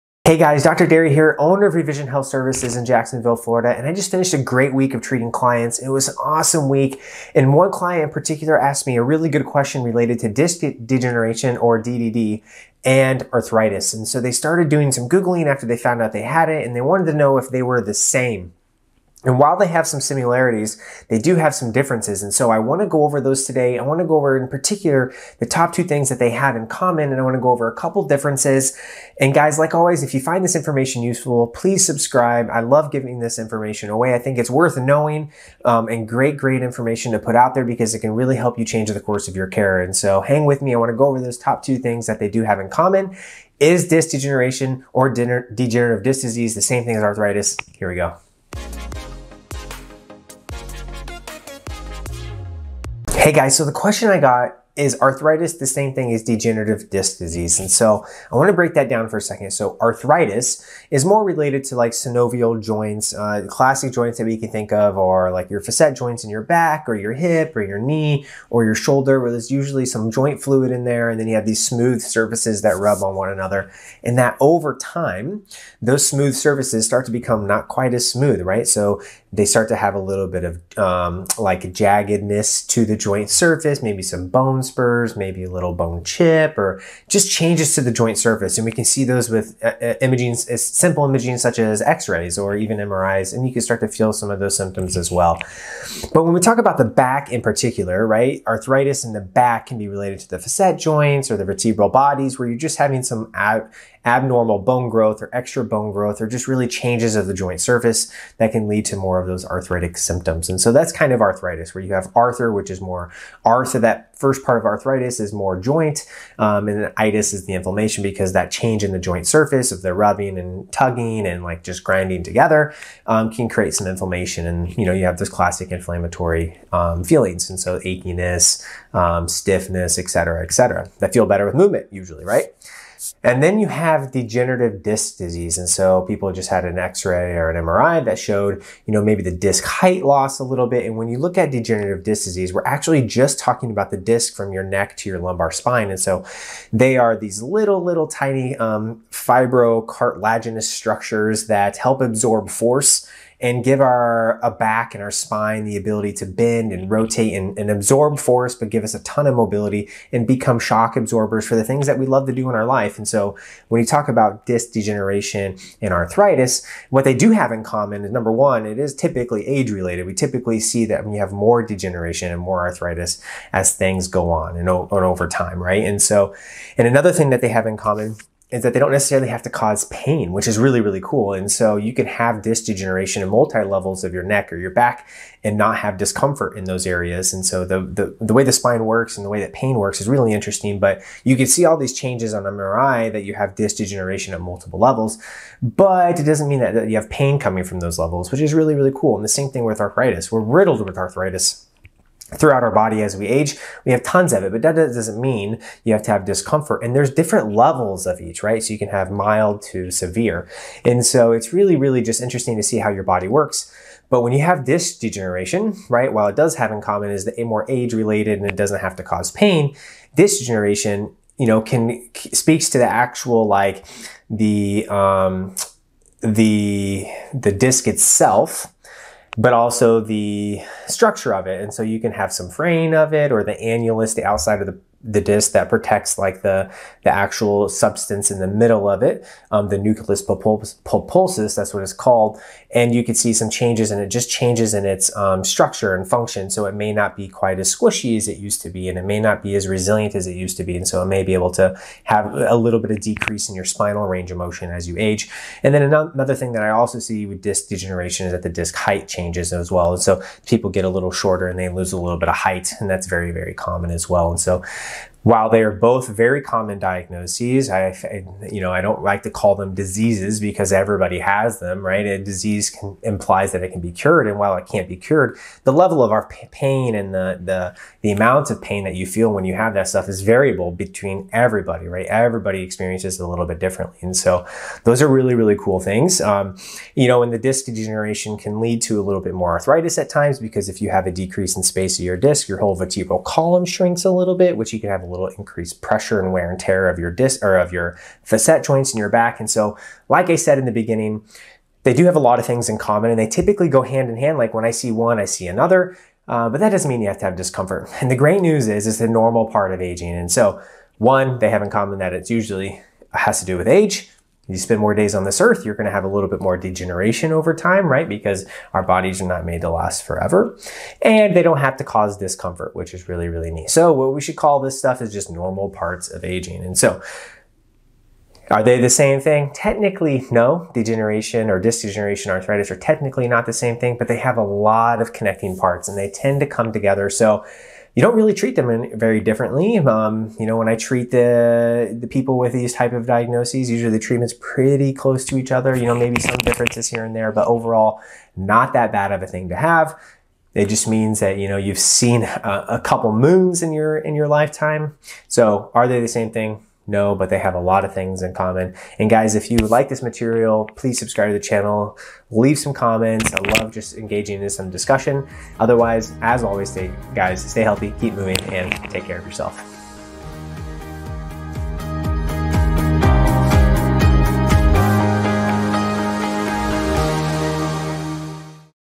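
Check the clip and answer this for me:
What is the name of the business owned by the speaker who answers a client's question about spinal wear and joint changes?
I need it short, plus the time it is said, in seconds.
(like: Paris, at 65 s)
Revision Health Services, at 1 s.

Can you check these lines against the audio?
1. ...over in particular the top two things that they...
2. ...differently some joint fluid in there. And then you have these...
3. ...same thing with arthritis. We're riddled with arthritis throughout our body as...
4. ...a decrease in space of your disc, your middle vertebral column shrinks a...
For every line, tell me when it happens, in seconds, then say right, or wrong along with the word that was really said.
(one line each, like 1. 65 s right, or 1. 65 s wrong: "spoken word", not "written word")
1. 24 s right
2. 69 s wrong: "usually", not "differently"
3. 199 s right
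4. 291 s wrong: "whole", not "middle".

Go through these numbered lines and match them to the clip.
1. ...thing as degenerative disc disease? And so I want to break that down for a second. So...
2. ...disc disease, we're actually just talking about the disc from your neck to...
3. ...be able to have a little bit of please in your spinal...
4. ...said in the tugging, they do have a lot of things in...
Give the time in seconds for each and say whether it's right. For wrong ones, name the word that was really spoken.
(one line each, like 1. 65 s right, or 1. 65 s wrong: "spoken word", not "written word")
1. 55 s right
2. 142 s right
3. 251 s wrong: "decrease", not "please"
4. 300 s wrong: "beginning", not "tugging".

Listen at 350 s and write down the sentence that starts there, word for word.
It just means that you know you've seen a, a couple moons in your in your lifetime.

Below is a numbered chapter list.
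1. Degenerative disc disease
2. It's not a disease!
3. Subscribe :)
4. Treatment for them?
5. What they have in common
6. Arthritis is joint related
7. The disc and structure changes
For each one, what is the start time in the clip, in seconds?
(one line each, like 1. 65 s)
1. 135 s
2. 275 s
3. 360 s
4. 346 s
5. 168 s
6. 56 s
7. 228 s.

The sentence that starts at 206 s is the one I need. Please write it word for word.
And there's different levels of each, right?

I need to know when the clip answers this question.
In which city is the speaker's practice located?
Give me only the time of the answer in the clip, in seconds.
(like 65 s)
2 s.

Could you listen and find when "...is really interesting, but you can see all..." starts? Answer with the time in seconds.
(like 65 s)
190 s.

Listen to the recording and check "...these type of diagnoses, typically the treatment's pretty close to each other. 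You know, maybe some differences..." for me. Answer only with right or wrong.
wrong.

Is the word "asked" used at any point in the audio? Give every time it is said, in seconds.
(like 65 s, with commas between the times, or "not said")
8 s.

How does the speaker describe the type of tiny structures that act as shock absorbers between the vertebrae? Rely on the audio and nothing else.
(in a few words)
fibrocartilaginous.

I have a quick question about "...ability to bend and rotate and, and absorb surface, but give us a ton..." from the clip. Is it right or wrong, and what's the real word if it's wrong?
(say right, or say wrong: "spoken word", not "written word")
wrong: "force", not "surface".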